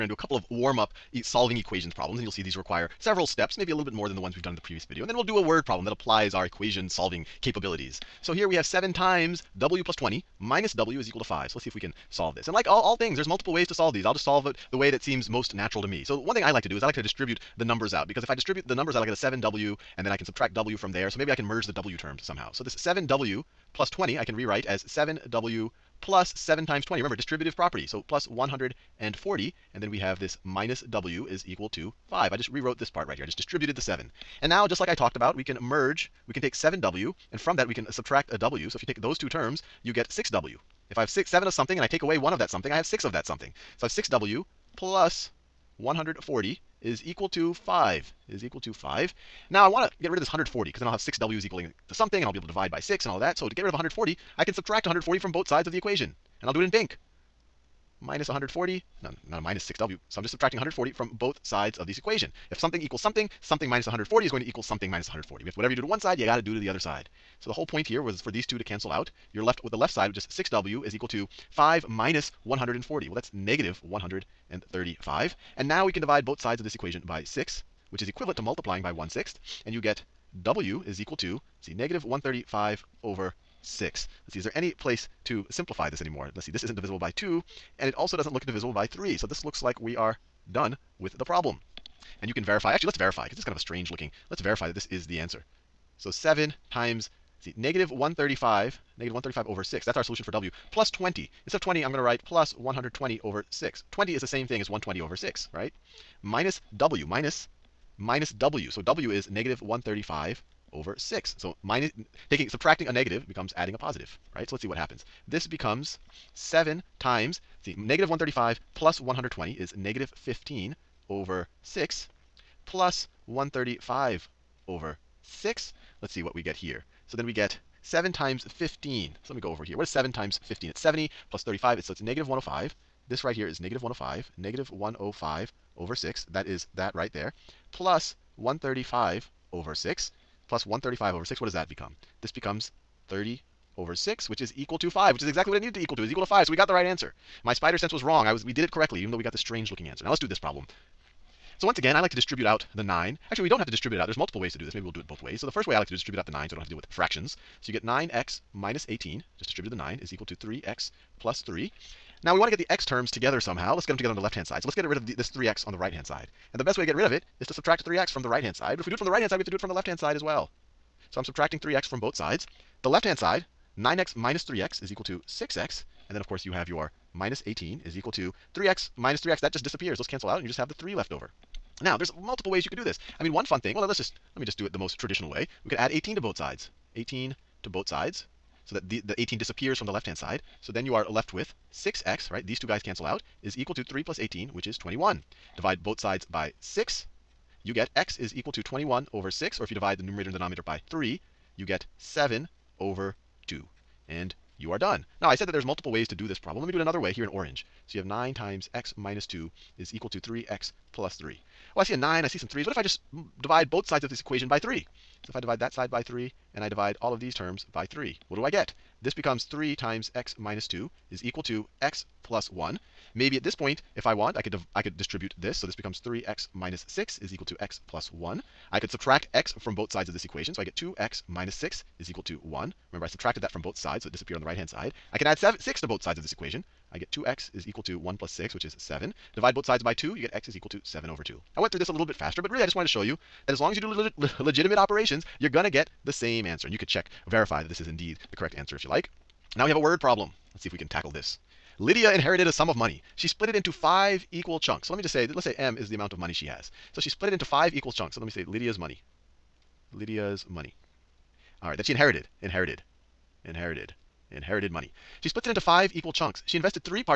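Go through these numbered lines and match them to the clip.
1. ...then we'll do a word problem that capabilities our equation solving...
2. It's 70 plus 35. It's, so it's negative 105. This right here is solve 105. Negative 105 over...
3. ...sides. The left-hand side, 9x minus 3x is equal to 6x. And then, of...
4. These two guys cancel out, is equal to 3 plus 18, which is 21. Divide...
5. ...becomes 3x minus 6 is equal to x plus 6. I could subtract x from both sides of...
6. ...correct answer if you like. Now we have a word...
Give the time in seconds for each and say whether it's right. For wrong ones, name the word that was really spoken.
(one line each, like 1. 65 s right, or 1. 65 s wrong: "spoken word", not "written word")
1. 5 s wrong: "applies", not "capabilities"
2. 130 s wrong: "negative", not "solve"
3. 172 s right
4. 192 s right
5. 225 s wrong: "1", not "6"
6. 248 s right.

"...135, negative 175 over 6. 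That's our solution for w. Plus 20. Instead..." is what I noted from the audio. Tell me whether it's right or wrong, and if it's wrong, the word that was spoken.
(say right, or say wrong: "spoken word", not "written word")
wrong: "135", not "175".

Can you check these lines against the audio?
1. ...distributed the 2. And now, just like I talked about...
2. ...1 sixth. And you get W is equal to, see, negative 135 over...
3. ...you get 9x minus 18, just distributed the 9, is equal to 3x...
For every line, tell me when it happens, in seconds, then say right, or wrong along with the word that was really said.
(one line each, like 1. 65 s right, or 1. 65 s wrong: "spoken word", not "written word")
1. 33 s wrong: "7", not "2"
2. 78 s right
3. 157 s right.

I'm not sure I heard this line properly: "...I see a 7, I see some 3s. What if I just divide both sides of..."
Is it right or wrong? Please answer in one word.
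wrong.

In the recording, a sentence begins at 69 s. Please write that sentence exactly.
You're left with the left side, which is 6w is equal to 5 minus 140.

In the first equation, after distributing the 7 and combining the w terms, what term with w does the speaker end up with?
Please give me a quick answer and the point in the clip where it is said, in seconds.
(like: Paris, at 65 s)
6w, at 39 s.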